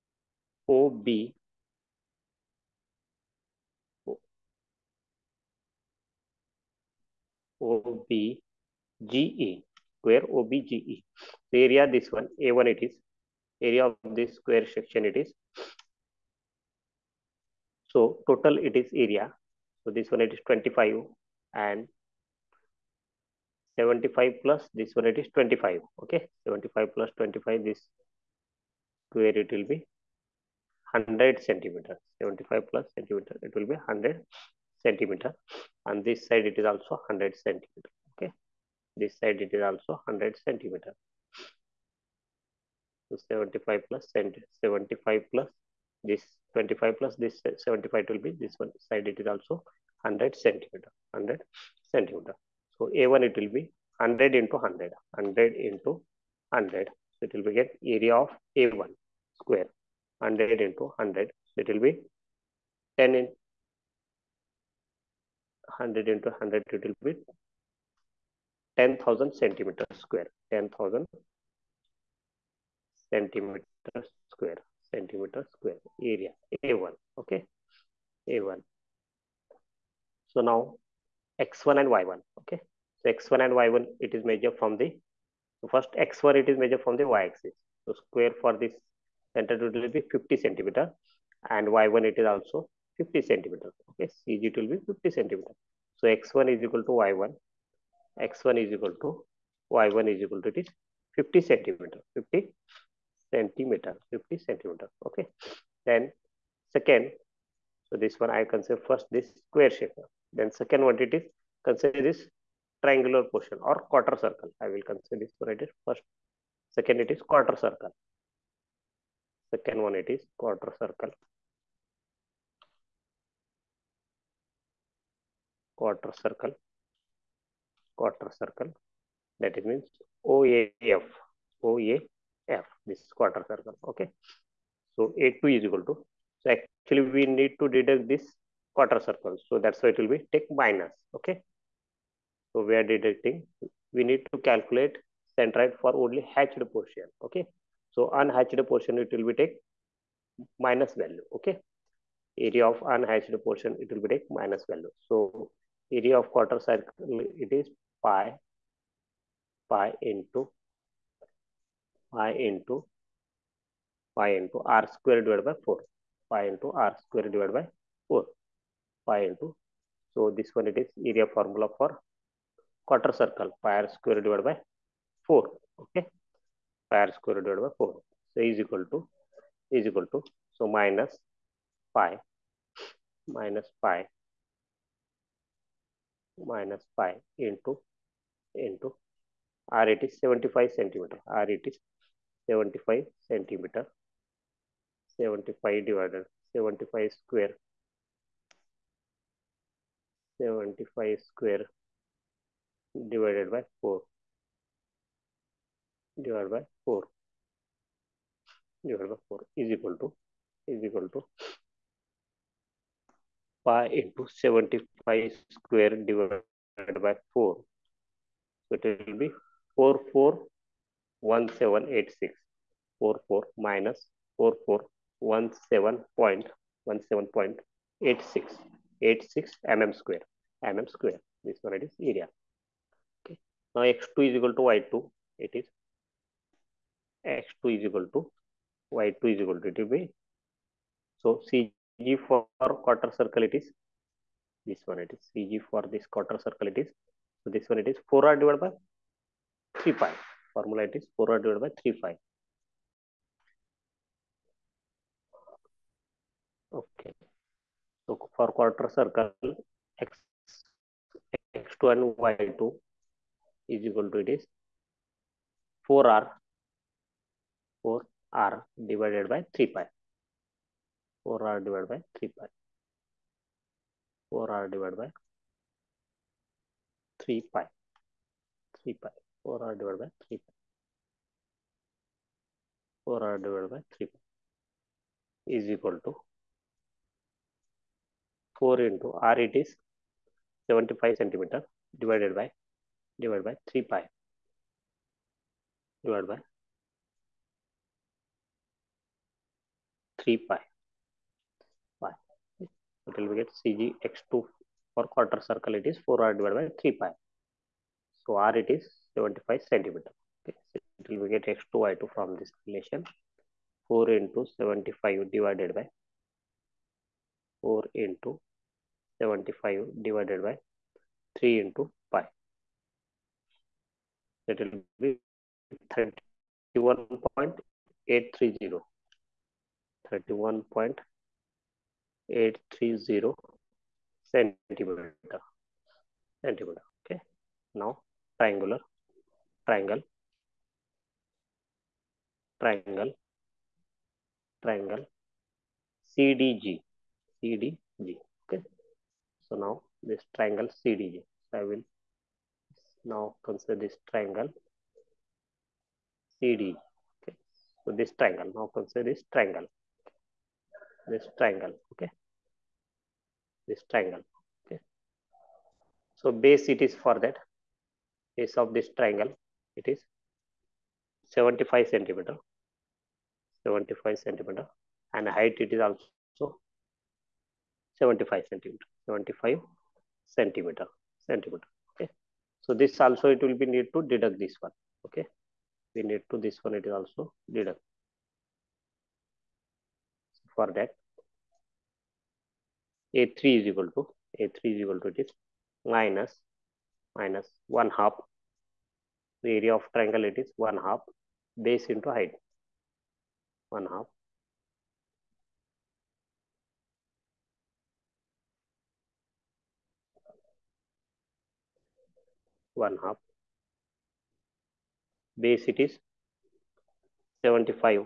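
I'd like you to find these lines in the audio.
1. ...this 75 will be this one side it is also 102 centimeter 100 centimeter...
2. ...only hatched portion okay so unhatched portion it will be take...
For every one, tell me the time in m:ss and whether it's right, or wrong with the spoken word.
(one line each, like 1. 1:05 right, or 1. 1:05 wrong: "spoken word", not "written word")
1. 0:47 wrong: "100", not "102"
2. 2:26 right.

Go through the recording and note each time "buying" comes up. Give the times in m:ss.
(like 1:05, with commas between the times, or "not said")
not said.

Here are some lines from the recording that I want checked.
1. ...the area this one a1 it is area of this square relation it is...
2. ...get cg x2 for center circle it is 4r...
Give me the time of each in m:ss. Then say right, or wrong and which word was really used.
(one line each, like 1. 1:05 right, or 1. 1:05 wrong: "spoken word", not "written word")
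1. 0:11 wrong: "section", not "relation"
2. 5:03 wrong: "quarter", not "center".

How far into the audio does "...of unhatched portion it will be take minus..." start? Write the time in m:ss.
2:32.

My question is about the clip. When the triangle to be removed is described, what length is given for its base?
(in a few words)
75 centimeters.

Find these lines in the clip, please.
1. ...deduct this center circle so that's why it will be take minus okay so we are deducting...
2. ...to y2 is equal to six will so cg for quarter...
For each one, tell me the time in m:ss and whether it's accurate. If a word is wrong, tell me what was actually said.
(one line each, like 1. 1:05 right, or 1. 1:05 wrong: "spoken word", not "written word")
1. 2:17 wrong: "quarter", not "center"
2. 3:58 wrong: "two", not "six".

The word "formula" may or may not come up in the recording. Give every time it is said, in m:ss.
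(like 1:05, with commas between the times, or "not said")
2:51, 4:10.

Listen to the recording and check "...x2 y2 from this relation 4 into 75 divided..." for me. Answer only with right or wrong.
right.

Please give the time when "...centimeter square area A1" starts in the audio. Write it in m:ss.
1:14.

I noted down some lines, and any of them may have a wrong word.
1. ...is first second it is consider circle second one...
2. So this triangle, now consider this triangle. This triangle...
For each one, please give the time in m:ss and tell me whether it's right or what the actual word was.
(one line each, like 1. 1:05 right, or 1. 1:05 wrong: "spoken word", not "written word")
1. 1:55 wrong: "quarter", not "consider"
2. 5:57 right.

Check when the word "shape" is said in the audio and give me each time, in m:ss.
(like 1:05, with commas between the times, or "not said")
1:49.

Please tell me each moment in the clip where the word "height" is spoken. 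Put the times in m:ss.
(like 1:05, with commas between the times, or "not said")
6:15, 6:42.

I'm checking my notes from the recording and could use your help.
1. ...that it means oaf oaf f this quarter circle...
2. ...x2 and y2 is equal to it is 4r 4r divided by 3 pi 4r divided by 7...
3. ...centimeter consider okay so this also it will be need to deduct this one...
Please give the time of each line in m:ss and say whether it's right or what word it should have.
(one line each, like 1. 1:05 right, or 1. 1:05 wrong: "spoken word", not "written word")
1. 2:09 right
2. 4:21 wrong: "3", not "7"
3. 6:20 wrong: "centimeter", not "consider".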